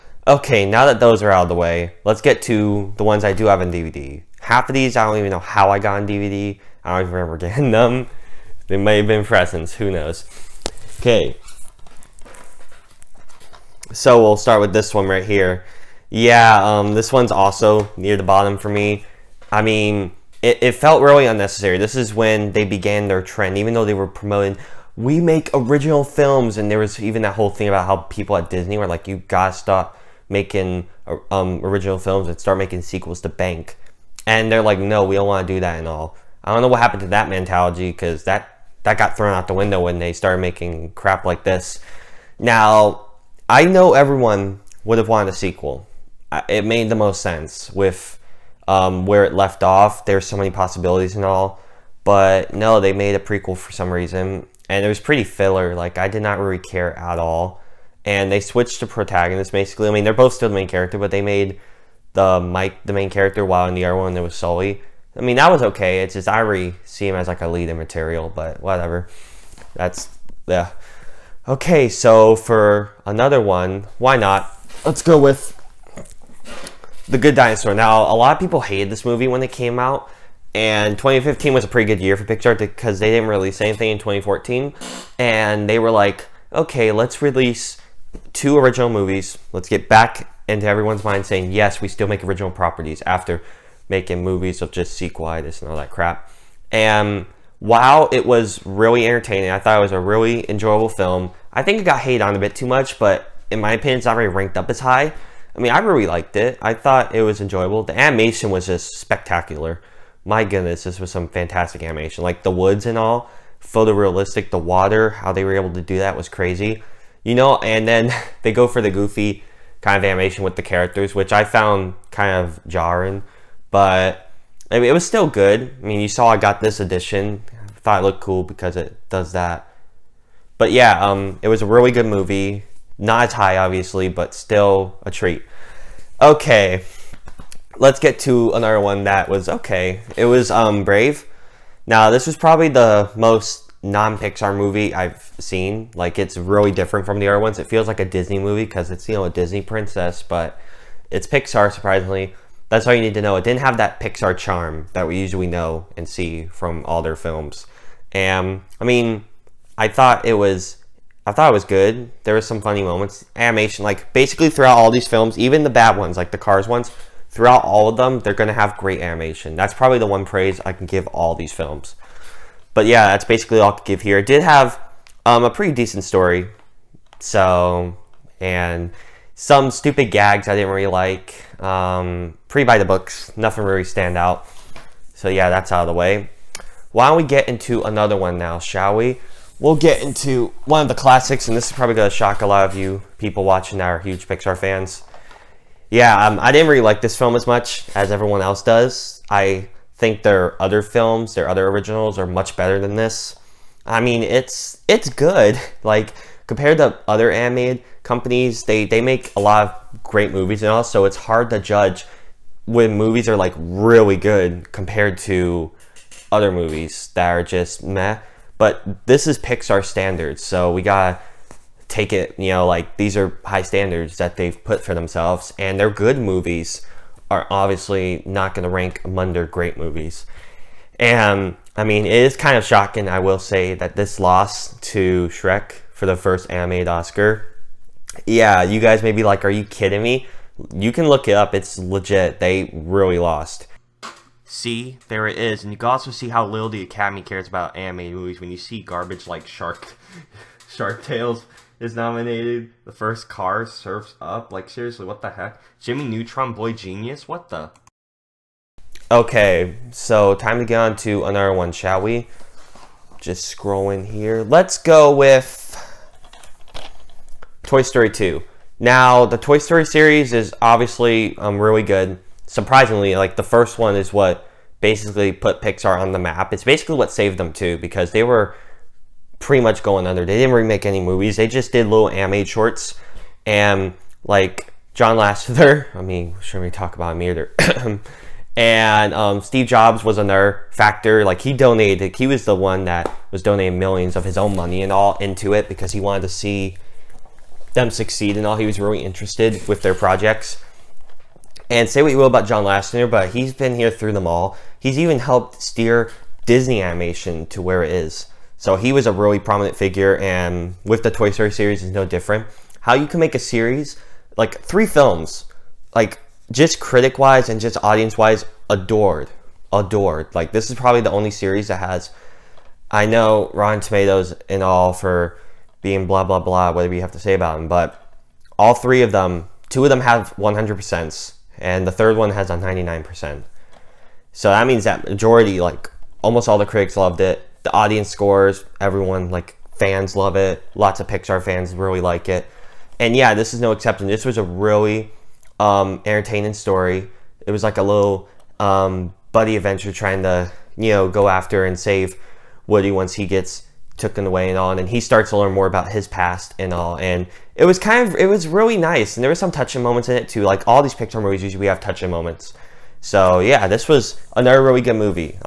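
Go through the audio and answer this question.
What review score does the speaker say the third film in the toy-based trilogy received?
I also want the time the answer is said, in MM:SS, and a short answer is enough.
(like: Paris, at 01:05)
99%, at 05:32.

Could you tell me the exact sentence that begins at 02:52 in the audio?
But yeah, that's basically all I could give here.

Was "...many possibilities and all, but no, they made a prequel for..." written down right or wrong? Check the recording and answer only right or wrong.
right.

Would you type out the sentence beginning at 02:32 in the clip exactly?
That's all you need to know.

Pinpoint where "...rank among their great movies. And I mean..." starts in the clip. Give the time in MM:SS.
03:48.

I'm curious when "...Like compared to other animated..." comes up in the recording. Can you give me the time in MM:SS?
03:25.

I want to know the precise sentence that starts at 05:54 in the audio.
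And he starts to learn more about his past and all.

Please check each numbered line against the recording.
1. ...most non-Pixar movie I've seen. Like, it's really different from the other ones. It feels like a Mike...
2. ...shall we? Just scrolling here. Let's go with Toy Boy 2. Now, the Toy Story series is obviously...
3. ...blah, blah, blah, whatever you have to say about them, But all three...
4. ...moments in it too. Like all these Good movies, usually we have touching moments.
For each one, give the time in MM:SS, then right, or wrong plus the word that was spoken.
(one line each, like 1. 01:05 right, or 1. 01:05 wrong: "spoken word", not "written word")
1. 02:23 wrong: "Disney", not "Mike"
2. 04:21 wrong: "Story", not "Boy"
3. 05:26 right
4. 05:59 wrong: "Pixar", not "Good".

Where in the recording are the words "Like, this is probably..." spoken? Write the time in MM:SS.
05:20.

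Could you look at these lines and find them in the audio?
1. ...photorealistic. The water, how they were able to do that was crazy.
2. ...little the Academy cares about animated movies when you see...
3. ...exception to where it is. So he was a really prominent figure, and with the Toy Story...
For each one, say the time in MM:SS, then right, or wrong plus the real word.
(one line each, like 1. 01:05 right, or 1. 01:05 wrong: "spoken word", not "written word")
1. 01:53 right
2. 04:06 right
3. 05:06 wrong: "animation", not "exception".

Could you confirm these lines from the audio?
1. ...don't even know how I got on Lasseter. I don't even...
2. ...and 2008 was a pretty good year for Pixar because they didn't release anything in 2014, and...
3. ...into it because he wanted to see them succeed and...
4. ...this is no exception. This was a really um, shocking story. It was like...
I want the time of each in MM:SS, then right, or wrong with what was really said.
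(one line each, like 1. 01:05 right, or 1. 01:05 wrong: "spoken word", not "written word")
1. 00:05 wrong: "DVD", not "Lasseter"
2. 01:20 wrong: "2015", not "2008"
3. 04:55 right
4. 05:43 wrong: "entertaining", not "shocking".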